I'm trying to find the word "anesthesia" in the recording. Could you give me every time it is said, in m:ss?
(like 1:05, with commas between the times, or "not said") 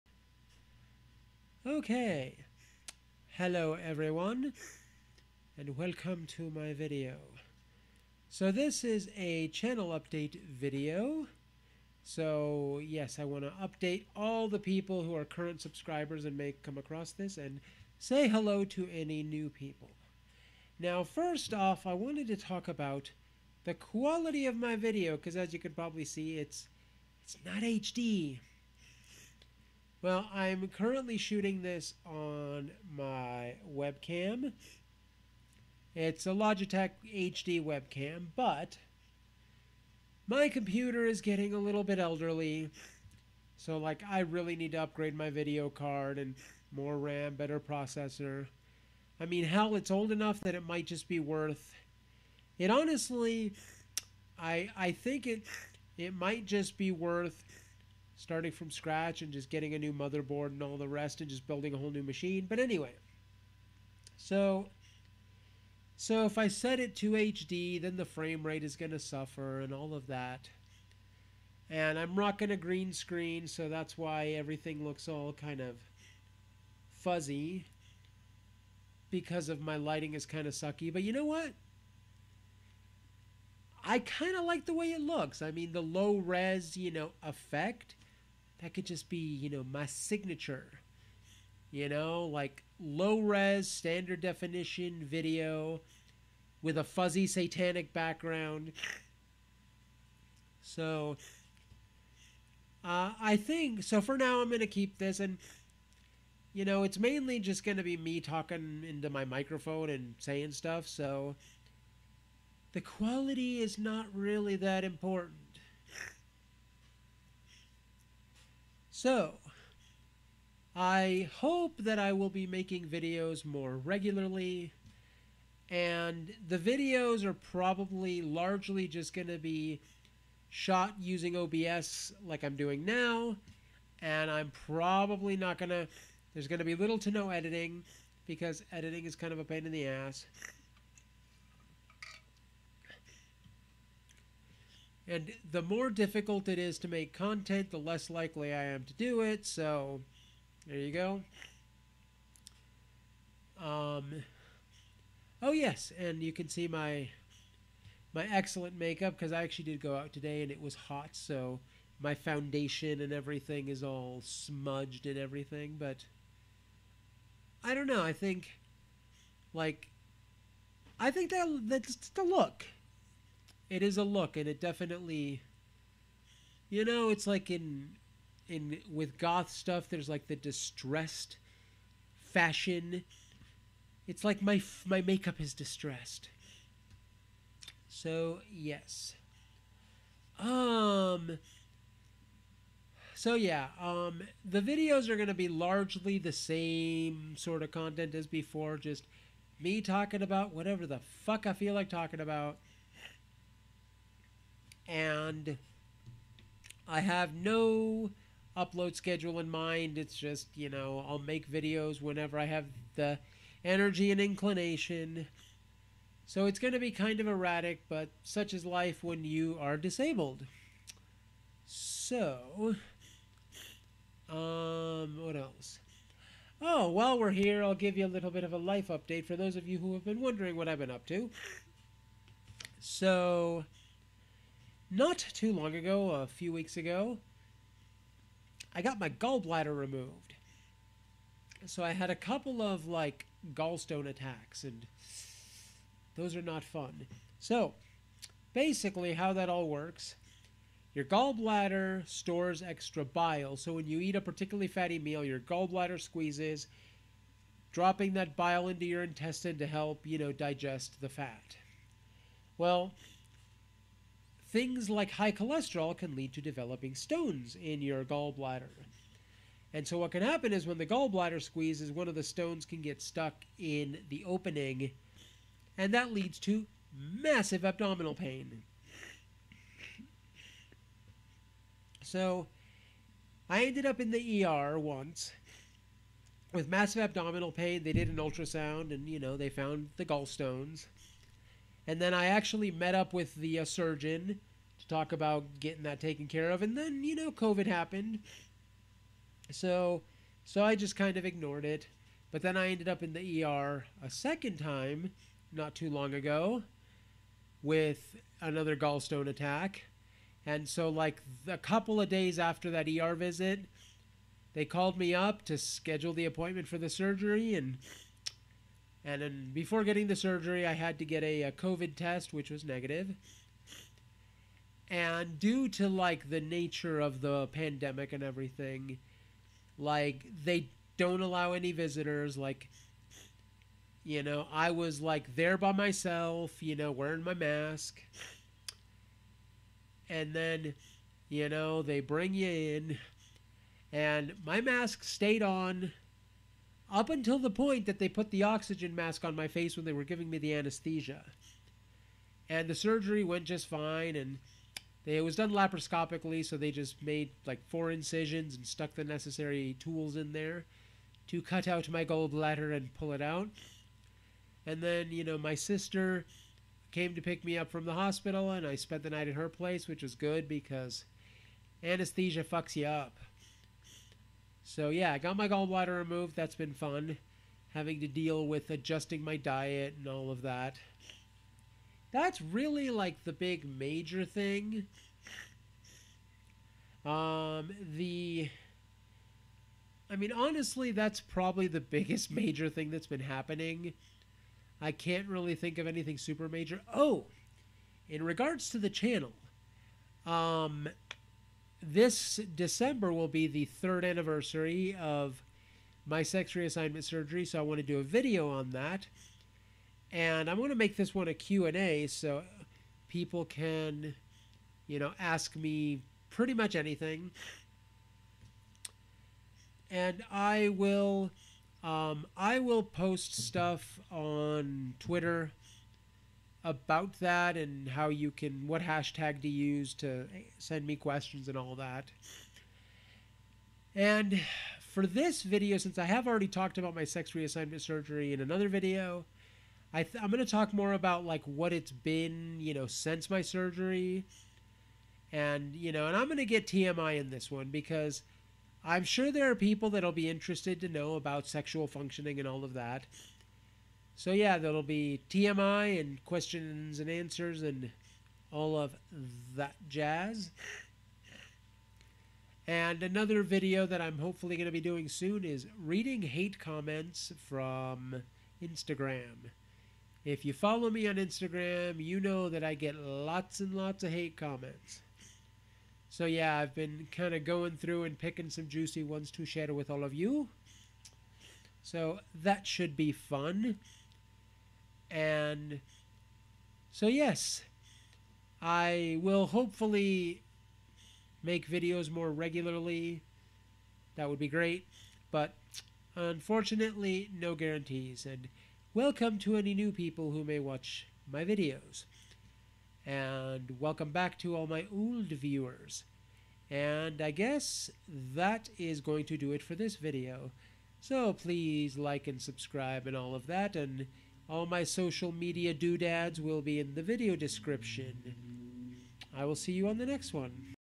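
5:50, 6:11.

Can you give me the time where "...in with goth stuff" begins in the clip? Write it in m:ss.
2:58.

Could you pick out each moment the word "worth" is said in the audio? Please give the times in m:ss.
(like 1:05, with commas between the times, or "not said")
0:51, 0:56.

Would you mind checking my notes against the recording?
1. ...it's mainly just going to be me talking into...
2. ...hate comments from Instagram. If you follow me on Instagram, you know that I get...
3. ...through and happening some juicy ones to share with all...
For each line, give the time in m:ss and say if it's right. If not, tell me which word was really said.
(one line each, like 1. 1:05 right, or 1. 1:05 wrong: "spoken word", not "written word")
1. 1:46 right
2. 7:46 right
3. 7:57 wrong: "picking", not "happening".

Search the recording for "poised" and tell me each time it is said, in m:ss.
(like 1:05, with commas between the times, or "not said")
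not said.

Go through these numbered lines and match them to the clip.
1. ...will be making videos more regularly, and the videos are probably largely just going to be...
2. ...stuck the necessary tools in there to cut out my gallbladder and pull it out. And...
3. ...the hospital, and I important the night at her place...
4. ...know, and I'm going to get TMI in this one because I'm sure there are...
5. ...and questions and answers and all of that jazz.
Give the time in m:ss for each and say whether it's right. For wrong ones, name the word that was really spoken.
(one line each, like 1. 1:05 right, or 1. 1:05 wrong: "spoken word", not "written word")
1. 2:02 right
2. 5:58 right
3. 6:07 wrong: "spent", not "important"
4. 7:25 right
5. 7:35 right.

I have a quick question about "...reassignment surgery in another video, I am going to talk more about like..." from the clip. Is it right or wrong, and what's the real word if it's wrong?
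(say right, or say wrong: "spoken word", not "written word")
right.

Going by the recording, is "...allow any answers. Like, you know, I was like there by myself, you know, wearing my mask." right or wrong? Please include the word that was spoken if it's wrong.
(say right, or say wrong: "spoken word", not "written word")
wrong: "visitors", not "answers".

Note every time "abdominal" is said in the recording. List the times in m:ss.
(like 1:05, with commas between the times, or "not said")
4:37, 4:47.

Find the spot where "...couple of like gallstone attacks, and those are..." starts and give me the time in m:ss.
4:02.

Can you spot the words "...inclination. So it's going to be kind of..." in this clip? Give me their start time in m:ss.
3:34.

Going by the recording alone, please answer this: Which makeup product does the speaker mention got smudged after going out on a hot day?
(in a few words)
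Foundation.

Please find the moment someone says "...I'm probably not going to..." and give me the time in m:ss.
2:14.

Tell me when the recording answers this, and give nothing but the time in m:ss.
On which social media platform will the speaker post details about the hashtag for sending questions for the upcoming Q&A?
7:04.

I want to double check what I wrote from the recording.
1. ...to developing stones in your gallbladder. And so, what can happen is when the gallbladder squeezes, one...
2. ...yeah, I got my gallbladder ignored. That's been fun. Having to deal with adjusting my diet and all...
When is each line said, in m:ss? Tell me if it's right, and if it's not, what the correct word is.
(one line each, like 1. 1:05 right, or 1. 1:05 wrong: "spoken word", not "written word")
1. 4:26 right
2. 6:14 wrong: "removed", not "ignored".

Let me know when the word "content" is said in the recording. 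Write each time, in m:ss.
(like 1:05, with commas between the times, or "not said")
2:27, 3:17.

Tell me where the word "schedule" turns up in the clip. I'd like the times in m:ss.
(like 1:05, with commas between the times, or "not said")
3:28, 5:15.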